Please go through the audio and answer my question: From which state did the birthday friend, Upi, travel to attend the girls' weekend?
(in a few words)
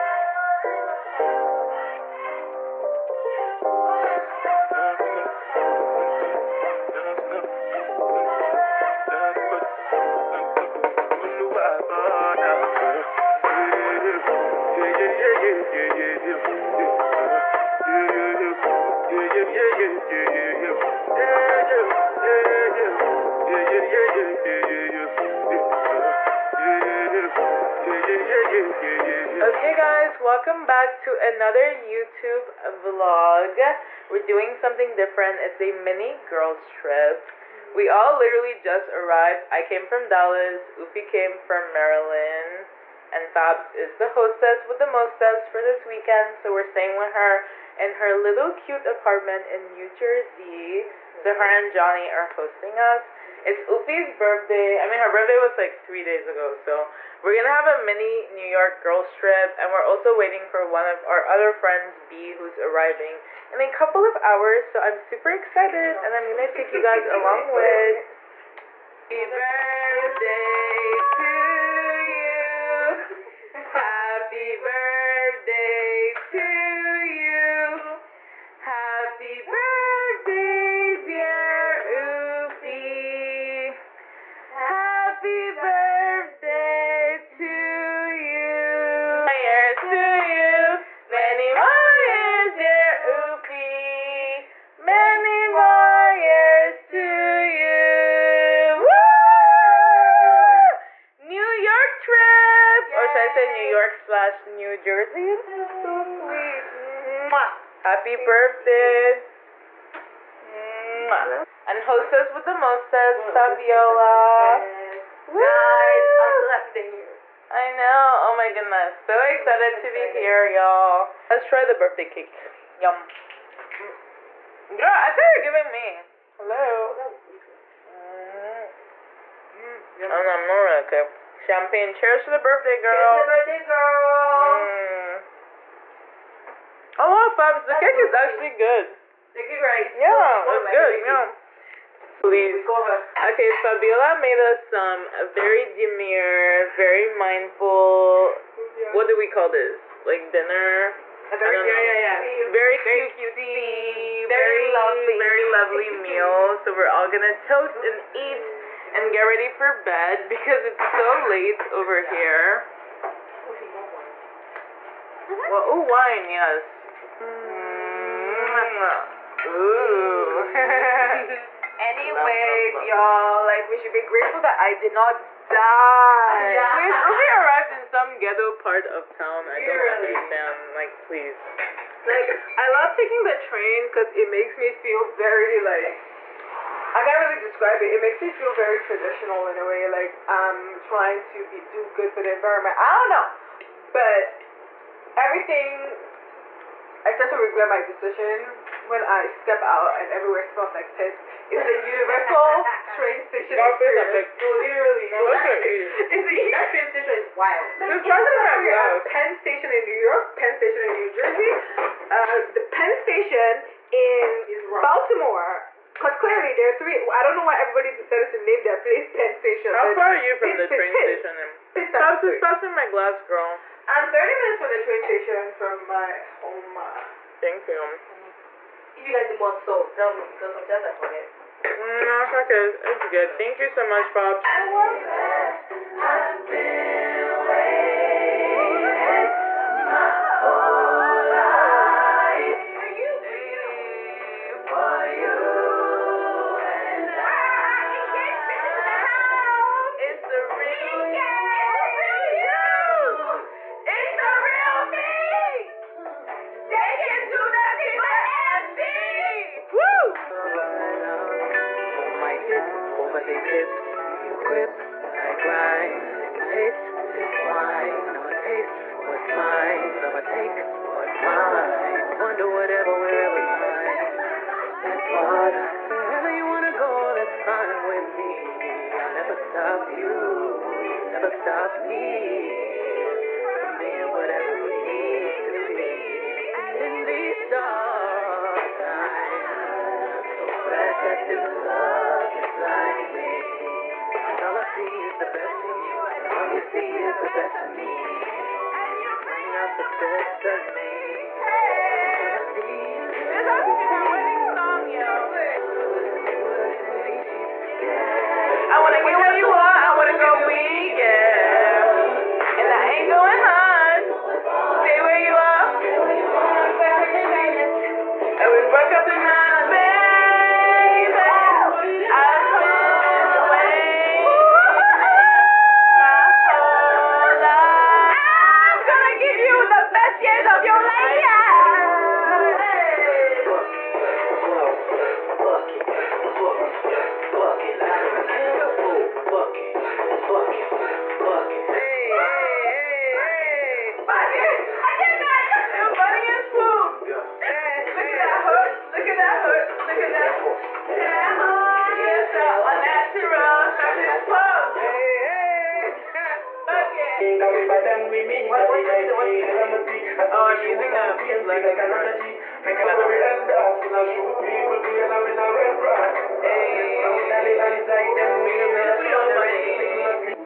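Maryland.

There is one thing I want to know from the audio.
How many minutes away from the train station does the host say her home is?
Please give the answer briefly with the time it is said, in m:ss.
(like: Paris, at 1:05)
30, at 3:44.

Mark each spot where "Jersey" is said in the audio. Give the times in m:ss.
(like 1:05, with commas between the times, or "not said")
0:49, 1:44, 3:31.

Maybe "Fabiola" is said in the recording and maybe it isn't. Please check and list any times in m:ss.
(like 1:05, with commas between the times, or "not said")
1:53, 2:23.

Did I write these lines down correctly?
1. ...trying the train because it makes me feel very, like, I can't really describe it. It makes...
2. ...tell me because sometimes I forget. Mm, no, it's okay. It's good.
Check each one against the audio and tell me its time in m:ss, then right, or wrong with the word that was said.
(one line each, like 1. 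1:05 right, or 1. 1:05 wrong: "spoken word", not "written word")
1. 3:02 wrong: "taking", not "trying"
2. 3:49 right.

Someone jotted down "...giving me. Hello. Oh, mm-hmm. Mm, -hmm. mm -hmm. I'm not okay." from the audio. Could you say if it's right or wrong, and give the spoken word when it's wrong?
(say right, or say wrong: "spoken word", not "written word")
right.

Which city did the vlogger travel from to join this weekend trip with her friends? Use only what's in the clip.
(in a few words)
Dallas.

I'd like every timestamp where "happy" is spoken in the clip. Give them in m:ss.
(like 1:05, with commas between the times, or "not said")
1:09, 1:13, 1:47, 1:56.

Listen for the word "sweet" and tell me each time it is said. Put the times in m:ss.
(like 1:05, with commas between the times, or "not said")
1:46, 2:18.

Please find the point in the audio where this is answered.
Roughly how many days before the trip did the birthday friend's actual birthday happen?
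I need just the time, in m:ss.
0:55.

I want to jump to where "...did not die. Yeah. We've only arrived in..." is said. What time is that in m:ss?
2:54.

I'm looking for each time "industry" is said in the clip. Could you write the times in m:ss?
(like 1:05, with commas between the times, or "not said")
not said.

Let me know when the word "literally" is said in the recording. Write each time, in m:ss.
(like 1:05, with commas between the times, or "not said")
0:38, 3:24.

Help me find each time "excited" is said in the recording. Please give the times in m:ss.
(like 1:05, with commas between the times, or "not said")
1:05, 1:59.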